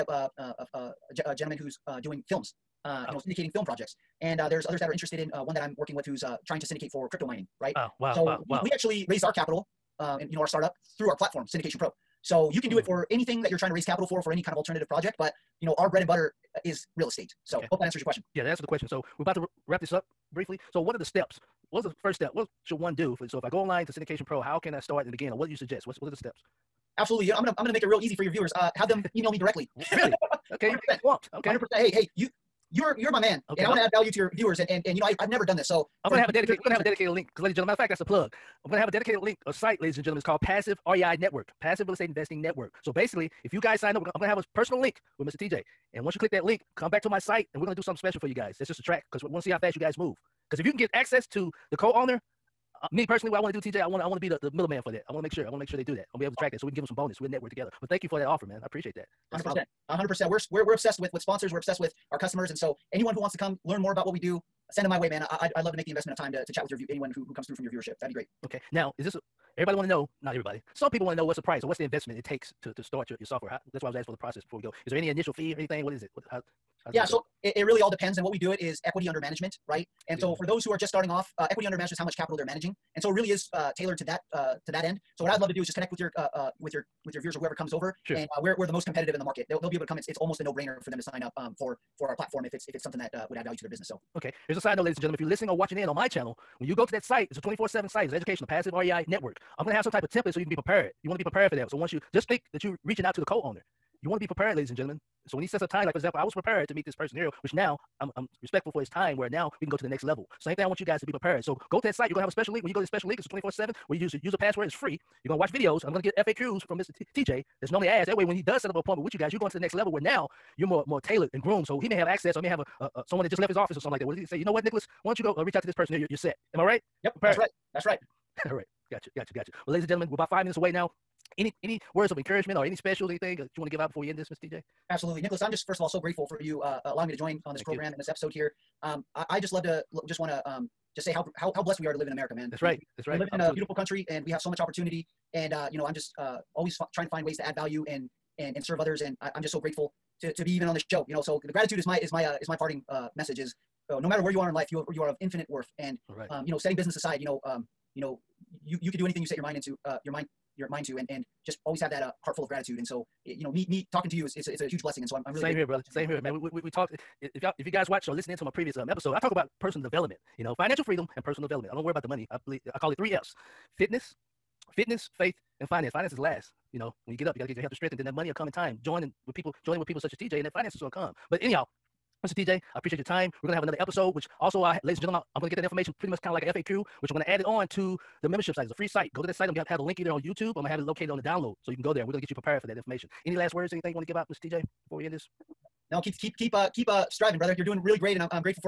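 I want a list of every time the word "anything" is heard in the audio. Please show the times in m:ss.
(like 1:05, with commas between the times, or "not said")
0:13, 1:15, 2:13, 2:39, 3:13.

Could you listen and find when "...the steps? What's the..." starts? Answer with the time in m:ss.
0:20.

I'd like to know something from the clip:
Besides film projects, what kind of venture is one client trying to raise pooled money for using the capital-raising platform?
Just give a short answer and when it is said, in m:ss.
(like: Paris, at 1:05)
crypto mining, at 0:07.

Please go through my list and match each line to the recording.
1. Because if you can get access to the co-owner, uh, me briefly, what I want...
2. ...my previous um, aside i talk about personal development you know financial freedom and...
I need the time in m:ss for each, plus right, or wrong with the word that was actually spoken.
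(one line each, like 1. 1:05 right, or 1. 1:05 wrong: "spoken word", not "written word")
1. 0:50 wrong: "personally", not "briefly"
2. 2:48 wrong: "episode", not "aside".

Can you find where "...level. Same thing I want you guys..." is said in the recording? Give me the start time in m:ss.
1:50.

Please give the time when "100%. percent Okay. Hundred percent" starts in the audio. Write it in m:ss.
0:30.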